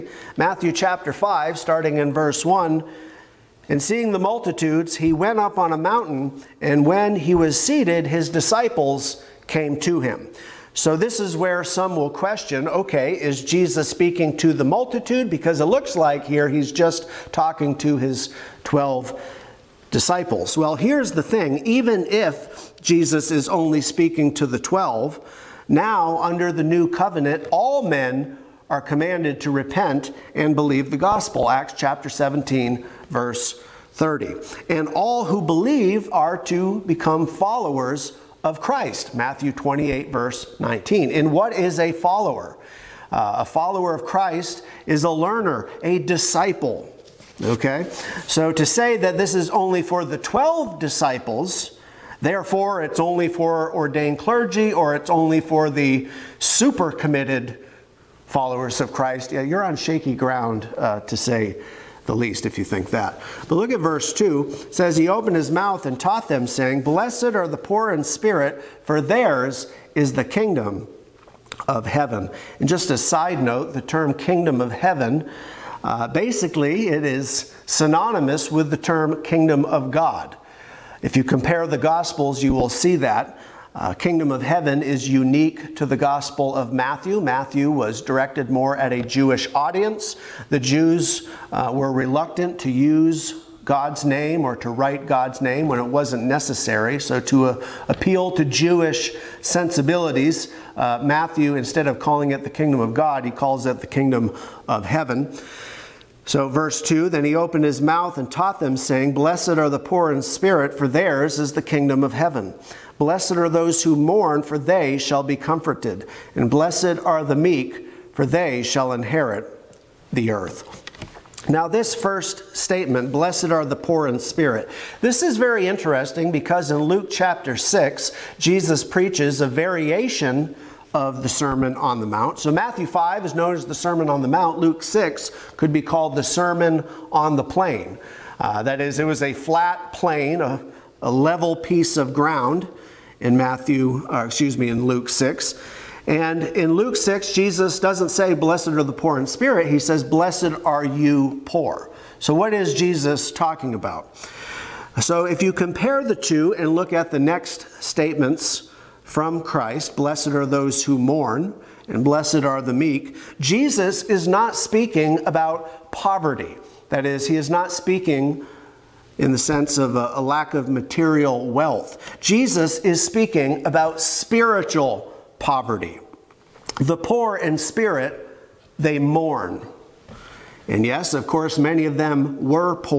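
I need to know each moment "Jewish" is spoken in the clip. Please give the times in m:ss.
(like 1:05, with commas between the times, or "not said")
1:29, 1:38.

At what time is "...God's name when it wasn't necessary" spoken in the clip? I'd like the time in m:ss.
1:35.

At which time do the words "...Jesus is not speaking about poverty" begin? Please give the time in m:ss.
2:43.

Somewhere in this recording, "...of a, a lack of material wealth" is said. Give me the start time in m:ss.
2:49.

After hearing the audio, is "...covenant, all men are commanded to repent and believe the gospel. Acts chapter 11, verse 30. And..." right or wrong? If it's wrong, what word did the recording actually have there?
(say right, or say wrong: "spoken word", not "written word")
wrong: "17", not "11".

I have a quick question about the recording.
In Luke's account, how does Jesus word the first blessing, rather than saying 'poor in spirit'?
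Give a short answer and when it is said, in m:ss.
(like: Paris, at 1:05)
Blessed are you poor, at 2:30.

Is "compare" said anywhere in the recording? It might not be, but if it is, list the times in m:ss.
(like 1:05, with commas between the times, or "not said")
1:21, 2:35.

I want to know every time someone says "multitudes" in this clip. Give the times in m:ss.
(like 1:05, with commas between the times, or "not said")
0:04, 0:14.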